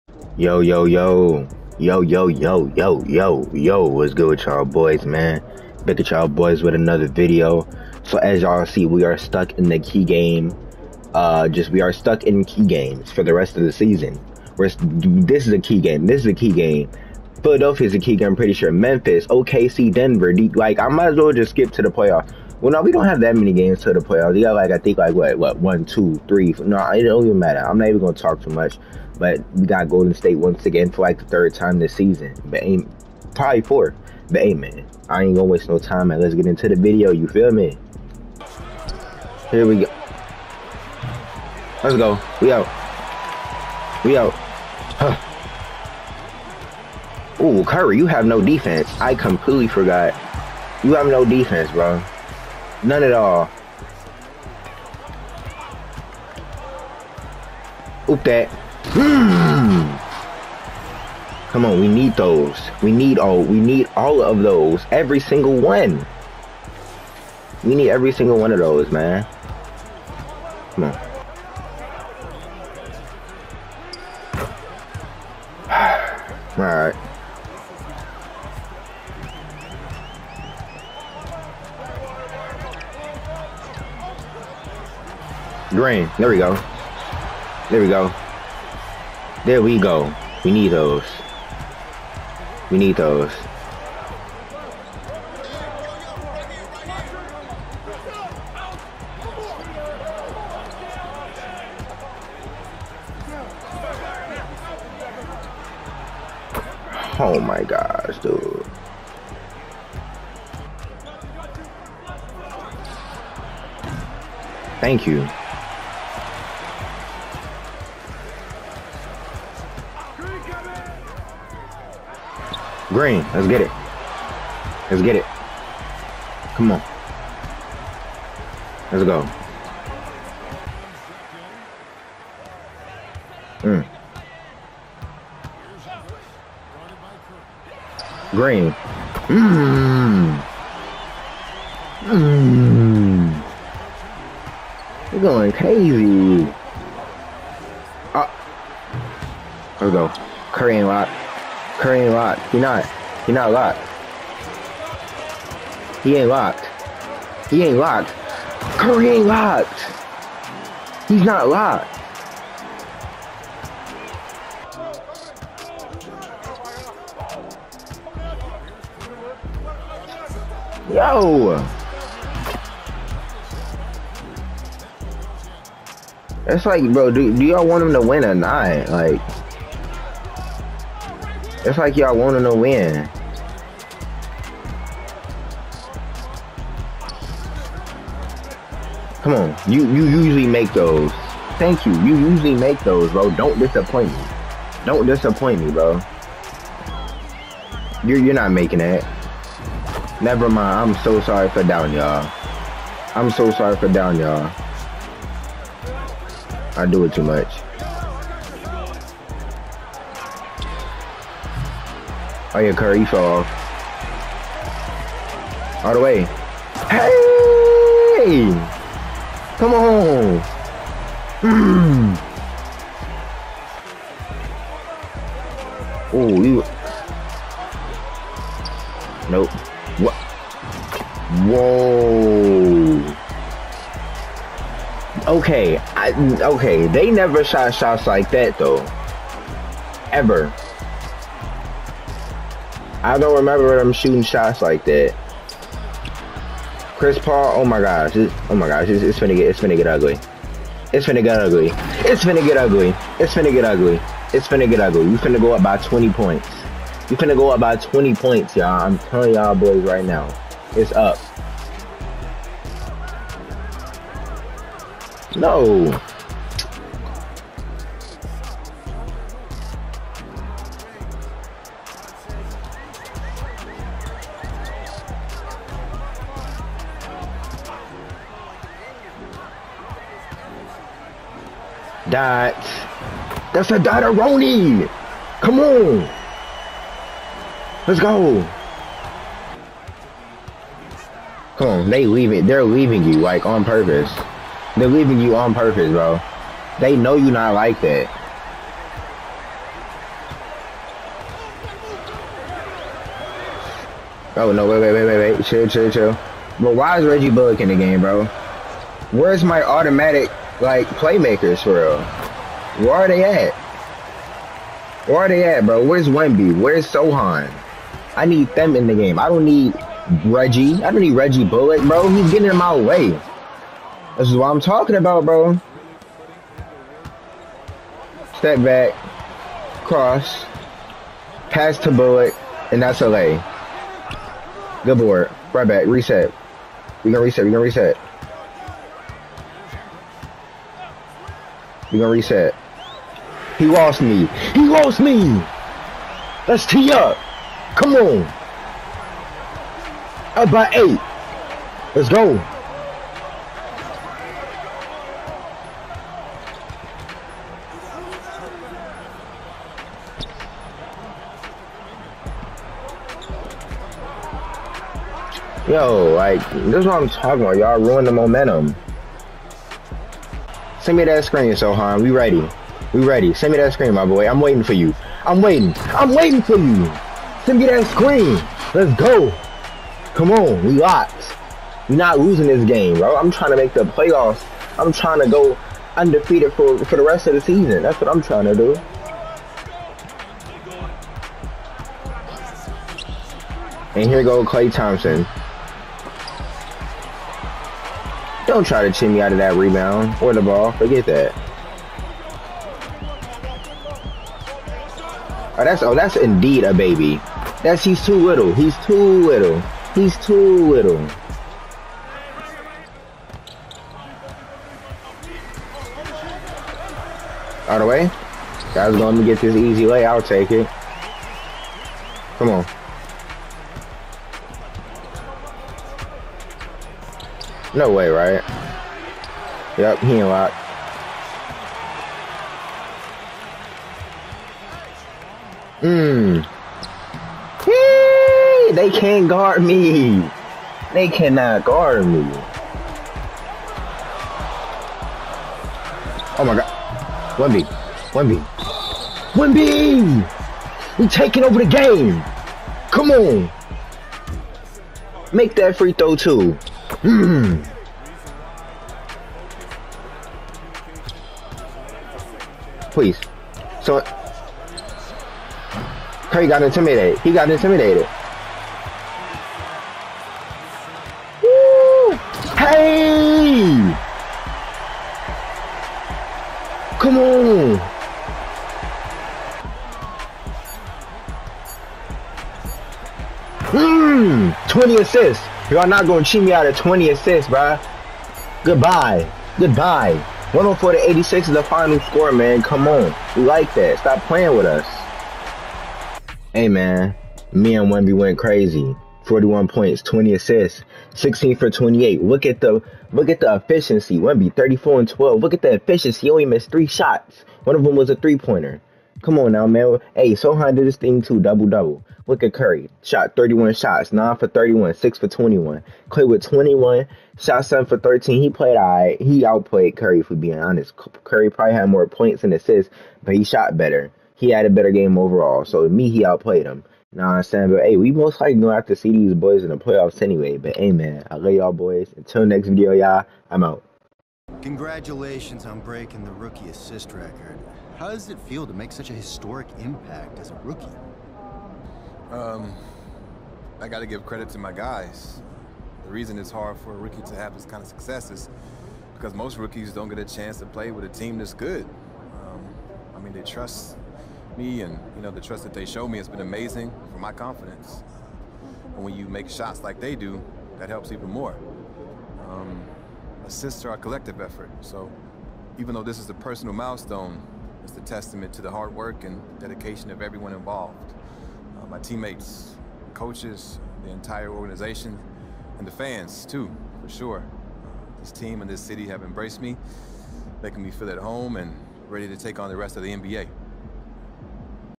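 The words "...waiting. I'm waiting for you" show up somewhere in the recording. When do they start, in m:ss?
6:15.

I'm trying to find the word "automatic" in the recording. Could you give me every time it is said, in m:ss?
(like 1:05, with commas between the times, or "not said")
5:09.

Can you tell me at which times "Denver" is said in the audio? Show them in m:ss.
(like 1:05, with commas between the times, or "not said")
0:19.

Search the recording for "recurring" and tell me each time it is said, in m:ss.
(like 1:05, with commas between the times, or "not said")
not said.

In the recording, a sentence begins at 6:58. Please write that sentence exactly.
Guys, going to get this easy way.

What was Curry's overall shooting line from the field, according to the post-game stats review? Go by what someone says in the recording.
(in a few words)
9 for 31.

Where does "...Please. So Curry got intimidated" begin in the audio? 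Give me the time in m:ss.
7:42.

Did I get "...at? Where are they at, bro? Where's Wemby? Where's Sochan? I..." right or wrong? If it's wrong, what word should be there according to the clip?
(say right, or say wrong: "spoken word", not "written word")
right.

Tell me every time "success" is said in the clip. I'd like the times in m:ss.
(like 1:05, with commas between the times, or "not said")
9:07.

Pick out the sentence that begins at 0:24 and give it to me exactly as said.
You got like I think like what what one, two, three.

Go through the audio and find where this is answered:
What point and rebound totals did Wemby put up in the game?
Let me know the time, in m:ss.
8:24.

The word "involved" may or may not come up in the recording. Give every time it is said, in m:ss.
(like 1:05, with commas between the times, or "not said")
9:30.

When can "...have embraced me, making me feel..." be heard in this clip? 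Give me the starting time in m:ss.
9:39.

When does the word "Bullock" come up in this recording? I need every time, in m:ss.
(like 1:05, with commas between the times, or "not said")
5:07, 5:21, 5:31.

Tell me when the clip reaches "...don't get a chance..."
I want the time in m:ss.
9:09.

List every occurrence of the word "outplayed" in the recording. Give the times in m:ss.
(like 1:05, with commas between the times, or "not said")
8:39, 8:46.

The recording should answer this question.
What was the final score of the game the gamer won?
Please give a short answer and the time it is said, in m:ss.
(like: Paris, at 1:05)
104 to 86, at 8:10.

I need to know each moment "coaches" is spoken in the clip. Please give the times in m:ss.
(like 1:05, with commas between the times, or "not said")
9:33.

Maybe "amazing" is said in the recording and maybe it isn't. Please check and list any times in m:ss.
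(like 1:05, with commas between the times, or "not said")
9:16.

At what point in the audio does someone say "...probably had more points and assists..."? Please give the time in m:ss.
8:41.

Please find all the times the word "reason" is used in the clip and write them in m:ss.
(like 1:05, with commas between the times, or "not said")
9:06.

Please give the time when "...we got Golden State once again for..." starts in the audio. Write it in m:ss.
0:29.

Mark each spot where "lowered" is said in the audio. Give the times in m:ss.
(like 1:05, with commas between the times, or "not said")
not said.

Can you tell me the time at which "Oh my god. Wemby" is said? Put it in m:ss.
7:26.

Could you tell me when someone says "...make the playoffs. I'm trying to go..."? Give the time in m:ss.
6:23.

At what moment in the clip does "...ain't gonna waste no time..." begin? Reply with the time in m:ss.
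0:35.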